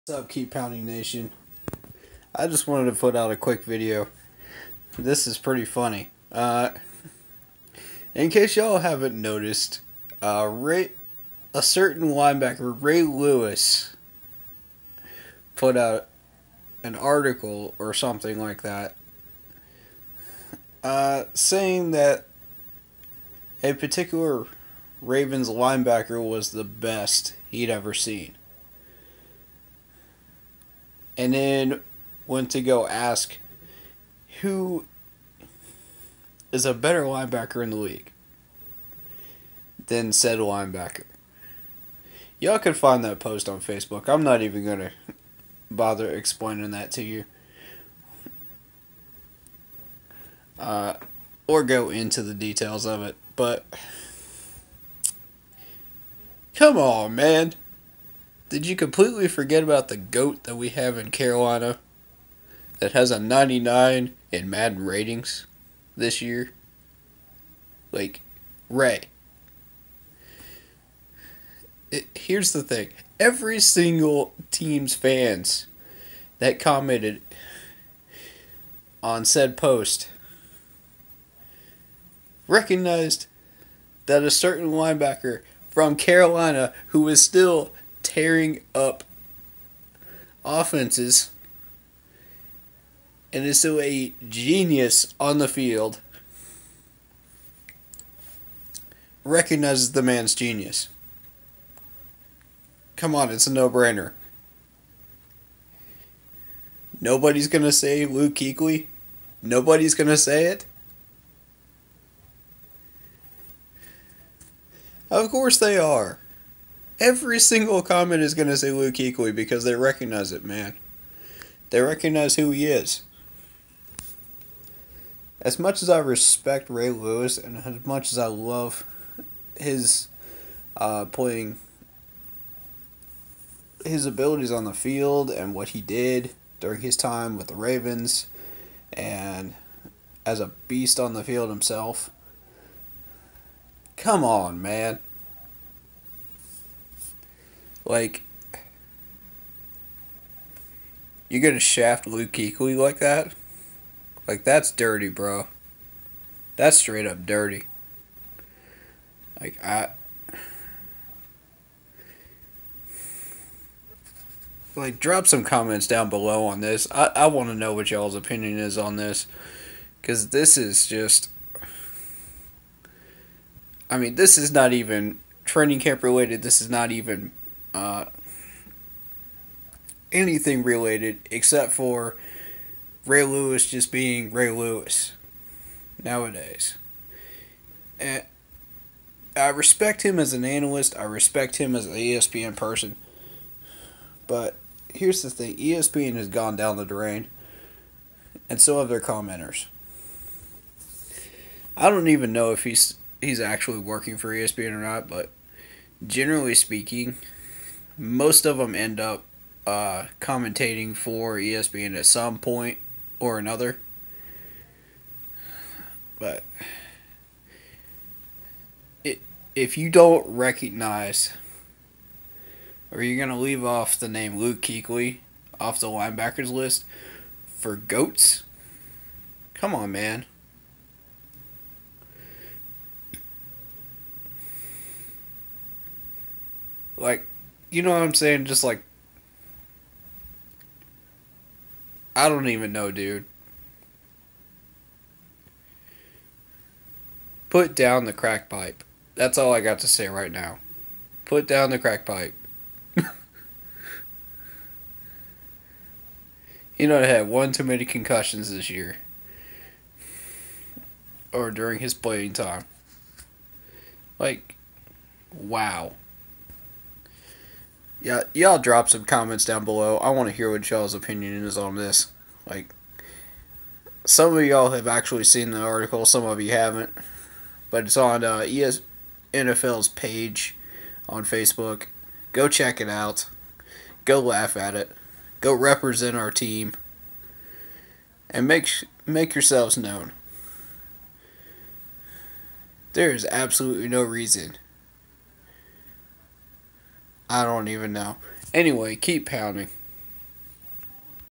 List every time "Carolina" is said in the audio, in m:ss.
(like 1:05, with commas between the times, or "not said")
1:01, 1:25.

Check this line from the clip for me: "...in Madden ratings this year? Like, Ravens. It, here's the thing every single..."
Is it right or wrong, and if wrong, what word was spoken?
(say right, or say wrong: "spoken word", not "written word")
wrong: "Ray", not "Ravens".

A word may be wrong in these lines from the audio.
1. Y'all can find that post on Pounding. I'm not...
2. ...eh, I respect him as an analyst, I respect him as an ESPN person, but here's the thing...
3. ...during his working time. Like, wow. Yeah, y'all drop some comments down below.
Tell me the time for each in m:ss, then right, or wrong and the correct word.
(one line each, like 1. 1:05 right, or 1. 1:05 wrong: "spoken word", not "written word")
1. 0:42 wrong: "Facebook", not "Pounding"
2. 3:08 right
3. 4:21 wrong: "playing", not "working".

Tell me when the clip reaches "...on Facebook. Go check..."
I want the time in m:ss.
4:41.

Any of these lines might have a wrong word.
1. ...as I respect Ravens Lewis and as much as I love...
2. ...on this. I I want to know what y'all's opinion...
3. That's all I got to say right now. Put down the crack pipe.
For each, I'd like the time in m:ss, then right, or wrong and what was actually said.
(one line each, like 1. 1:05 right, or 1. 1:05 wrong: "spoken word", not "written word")
1. 2:05 wrong: "Ray", not "Ravens"
2. 2:46 right
3. 4:09 right.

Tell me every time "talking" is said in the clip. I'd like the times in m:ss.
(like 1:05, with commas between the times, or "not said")
not said.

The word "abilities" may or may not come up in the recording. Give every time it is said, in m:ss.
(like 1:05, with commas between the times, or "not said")
2:14.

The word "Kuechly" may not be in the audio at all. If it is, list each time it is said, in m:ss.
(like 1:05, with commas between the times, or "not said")
1:48, 1:58, 2:32, 3:44.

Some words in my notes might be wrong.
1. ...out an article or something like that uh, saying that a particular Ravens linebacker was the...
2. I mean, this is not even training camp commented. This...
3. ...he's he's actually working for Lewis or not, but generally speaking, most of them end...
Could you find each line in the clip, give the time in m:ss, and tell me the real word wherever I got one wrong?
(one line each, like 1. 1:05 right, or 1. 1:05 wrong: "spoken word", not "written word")
1. 0:15 right
2. 2:53 wrong: "related", not "commented"
3. 3:22 wrong: "ESPN", not "Lewis".